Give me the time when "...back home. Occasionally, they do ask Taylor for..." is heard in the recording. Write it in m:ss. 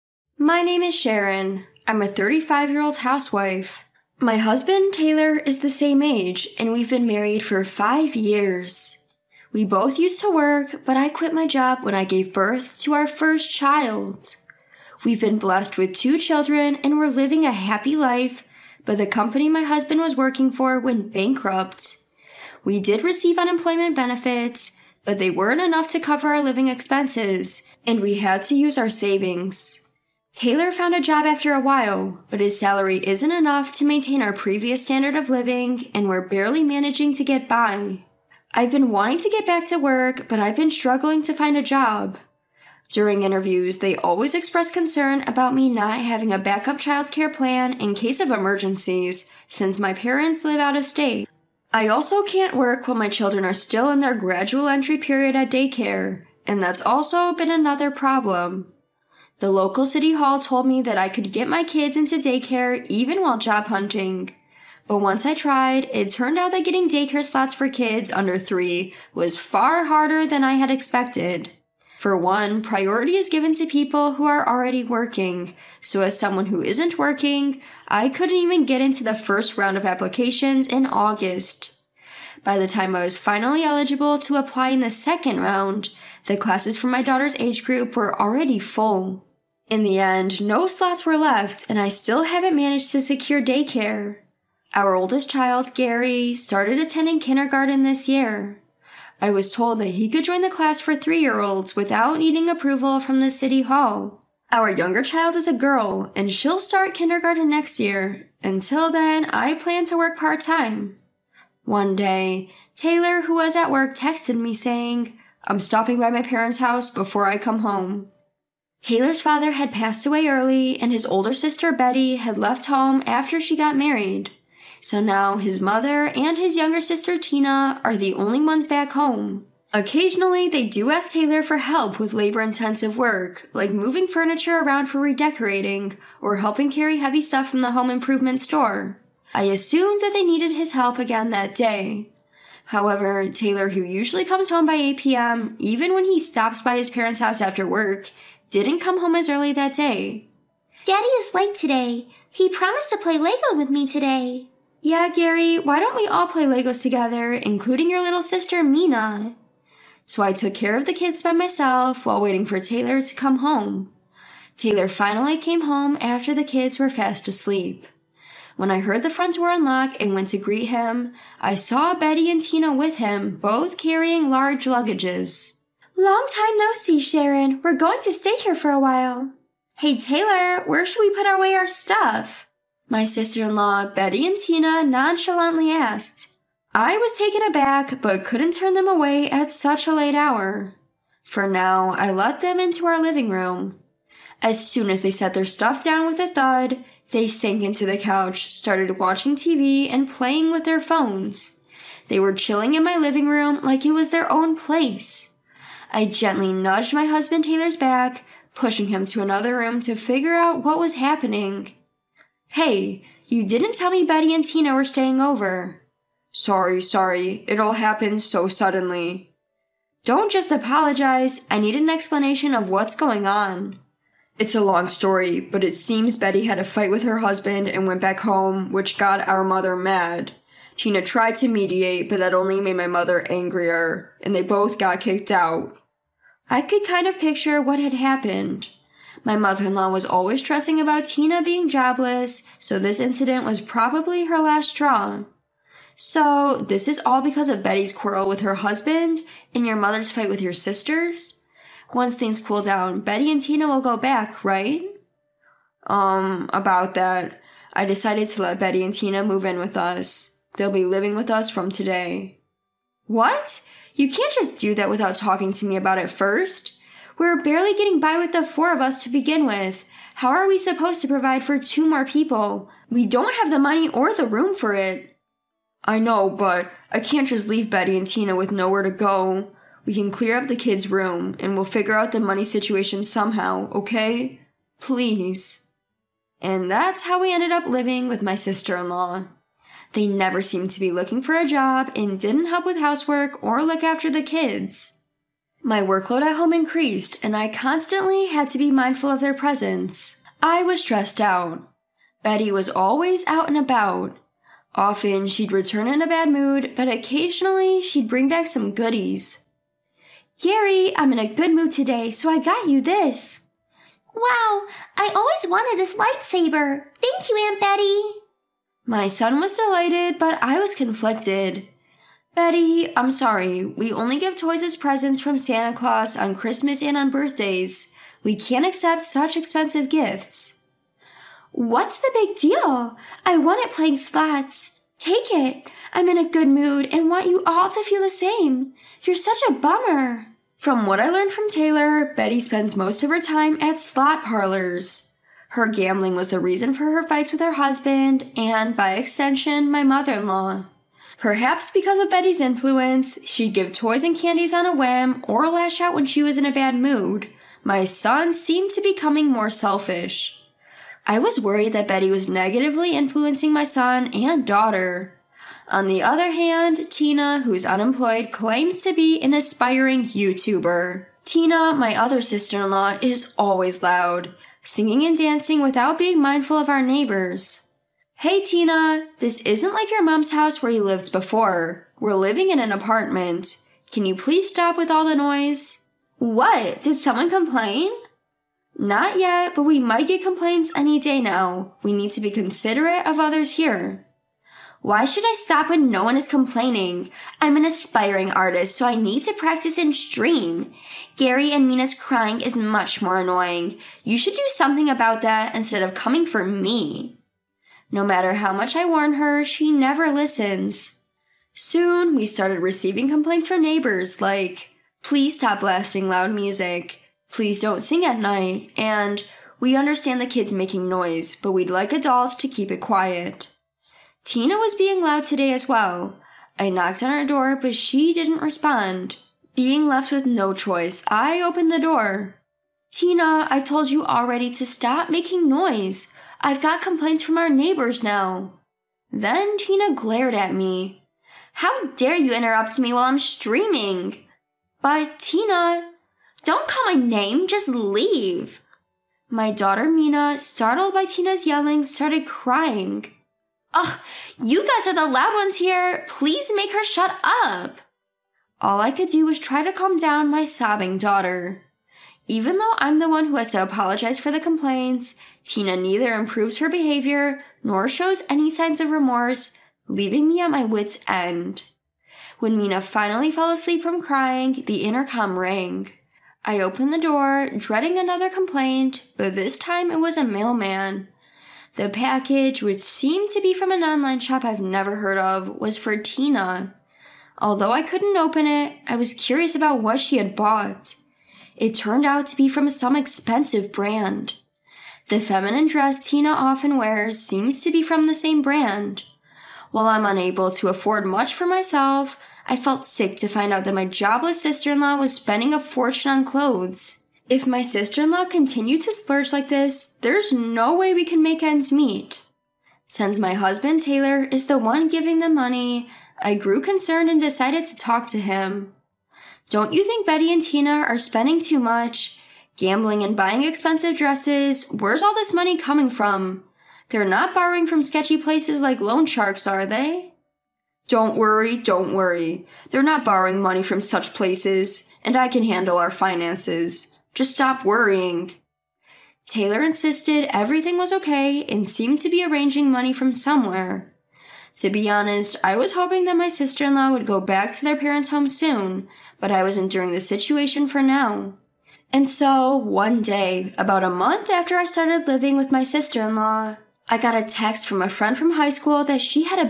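2:08.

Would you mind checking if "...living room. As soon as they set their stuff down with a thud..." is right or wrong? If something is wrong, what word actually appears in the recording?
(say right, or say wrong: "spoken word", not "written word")
right.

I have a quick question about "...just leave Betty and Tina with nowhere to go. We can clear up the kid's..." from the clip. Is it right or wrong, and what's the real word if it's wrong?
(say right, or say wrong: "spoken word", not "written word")
right.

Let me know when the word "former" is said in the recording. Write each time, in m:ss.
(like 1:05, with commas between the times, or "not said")
not said.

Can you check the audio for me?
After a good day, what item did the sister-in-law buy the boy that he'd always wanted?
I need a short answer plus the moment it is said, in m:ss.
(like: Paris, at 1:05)
lightsaber, at 5:15.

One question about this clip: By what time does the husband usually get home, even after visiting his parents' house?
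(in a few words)
8 p.m.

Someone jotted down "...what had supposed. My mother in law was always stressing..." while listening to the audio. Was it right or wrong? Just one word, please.
wrong.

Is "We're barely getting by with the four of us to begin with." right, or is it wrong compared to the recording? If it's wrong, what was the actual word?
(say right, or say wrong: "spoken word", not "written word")
right.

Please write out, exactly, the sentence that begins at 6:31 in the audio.
We need to be considerate of others here.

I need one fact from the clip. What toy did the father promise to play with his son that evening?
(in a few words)
Lego.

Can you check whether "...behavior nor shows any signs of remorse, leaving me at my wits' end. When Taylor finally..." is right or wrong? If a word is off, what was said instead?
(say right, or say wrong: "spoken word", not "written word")
wrong: "Mina", not "Taylor".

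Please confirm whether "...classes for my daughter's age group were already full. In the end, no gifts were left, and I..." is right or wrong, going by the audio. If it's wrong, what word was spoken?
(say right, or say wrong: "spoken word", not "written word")
wrong: "slots", not "gifts".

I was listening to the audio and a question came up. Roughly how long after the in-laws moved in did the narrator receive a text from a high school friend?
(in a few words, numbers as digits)
a month.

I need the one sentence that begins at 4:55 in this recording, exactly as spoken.
My workload at home increased, and I constantly had to be mindful of their presence.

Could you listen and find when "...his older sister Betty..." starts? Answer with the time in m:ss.
2:00.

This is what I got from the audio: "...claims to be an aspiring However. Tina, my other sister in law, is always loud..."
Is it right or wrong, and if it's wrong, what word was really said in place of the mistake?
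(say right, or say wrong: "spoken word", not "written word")
wrong: "YouTuber", not "However".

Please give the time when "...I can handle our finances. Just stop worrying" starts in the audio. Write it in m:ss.
8:55.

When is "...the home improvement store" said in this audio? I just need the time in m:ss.
2:17.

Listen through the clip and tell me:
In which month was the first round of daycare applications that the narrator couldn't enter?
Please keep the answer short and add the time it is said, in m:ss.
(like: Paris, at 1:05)
August, at 1:20.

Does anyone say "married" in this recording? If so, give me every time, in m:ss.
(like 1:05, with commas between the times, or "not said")
0:07, 2:03.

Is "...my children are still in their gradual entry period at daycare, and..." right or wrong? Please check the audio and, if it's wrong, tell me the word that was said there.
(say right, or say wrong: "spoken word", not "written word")
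right.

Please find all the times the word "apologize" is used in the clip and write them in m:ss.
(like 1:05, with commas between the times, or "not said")
3:40, 7:43.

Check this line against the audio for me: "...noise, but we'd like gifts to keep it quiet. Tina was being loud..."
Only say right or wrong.
wrong.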